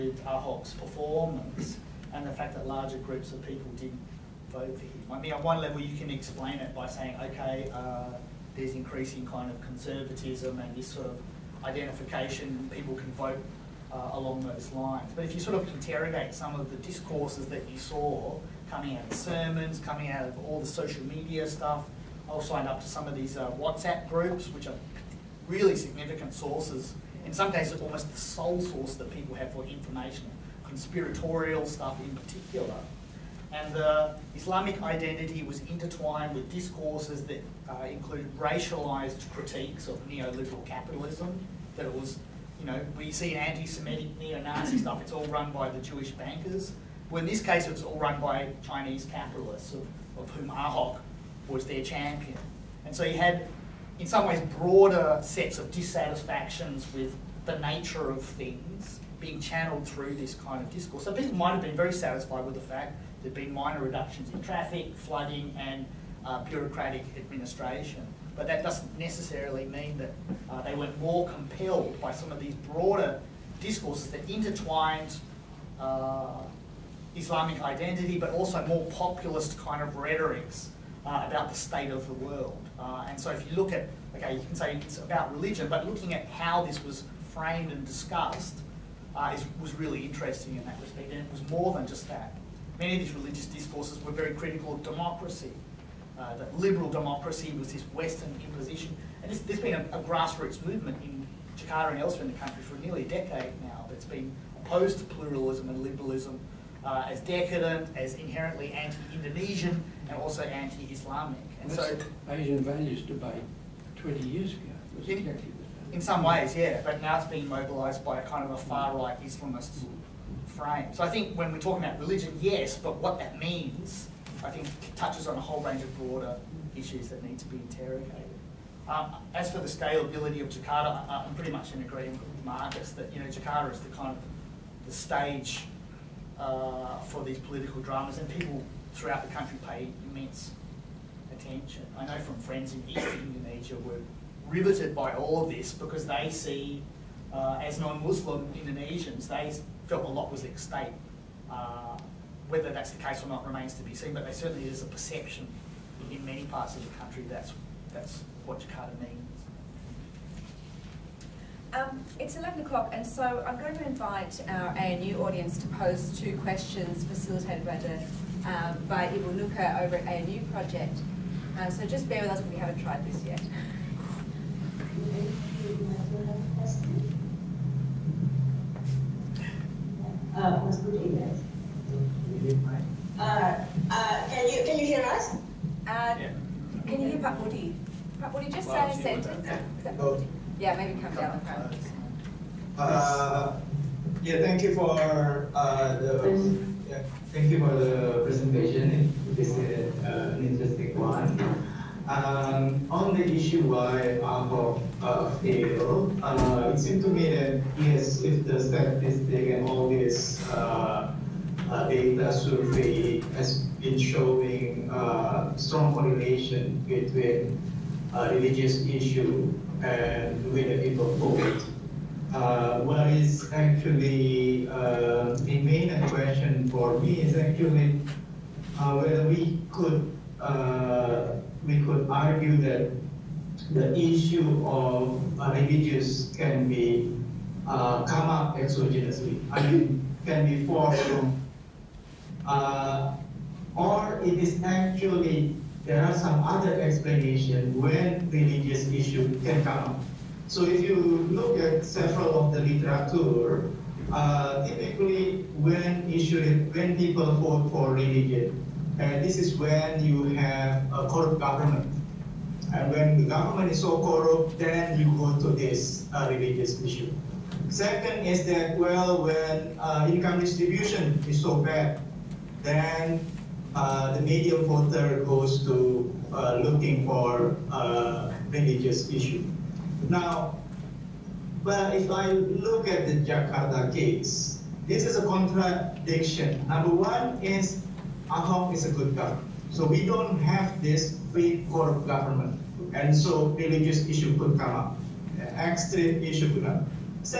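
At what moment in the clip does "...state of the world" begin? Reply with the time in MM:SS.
01:21.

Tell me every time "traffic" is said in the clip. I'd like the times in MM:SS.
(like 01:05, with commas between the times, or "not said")
01:04.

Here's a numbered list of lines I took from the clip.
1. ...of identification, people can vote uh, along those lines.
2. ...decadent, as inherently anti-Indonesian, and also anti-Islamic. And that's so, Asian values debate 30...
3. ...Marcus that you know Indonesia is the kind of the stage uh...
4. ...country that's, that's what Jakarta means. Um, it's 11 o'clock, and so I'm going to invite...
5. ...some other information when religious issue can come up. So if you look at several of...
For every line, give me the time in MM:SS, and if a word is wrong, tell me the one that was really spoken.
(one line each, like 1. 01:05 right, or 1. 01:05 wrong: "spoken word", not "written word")
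1. 00:11 right
2. 01:47 wrong: "20", not "30"
3. 02:12 wrong: "Jakarta", not "Indonesia"
4. 02:36 right
5. 04:06 wrong: "explanation", not "information".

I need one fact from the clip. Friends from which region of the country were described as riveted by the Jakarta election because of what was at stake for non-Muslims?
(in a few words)
East Indonesia.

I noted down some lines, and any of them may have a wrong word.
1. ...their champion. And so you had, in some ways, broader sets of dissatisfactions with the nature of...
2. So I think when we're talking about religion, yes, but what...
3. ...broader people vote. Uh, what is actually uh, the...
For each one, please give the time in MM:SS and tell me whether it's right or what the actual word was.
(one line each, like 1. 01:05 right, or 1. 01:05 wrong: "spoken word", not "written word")
1. 00:51 right
2. 02:00 right
3. 03:40 wrong: "whether", not "broader".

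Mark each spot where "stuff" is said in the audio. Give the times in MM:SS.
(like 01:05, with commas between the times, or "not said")
00:21, 00:31, 00:44.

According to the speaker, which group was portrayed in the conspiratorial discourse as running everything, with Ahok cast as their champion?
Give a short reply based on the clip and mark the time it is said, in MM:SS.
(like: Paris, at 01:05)
Chinese capitalists, at 00:48.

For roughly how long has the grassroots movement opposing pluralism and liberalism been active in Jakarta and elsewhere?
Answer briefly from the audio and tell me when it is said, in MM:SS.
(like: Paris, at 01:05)
nearly a decade, at 01:42.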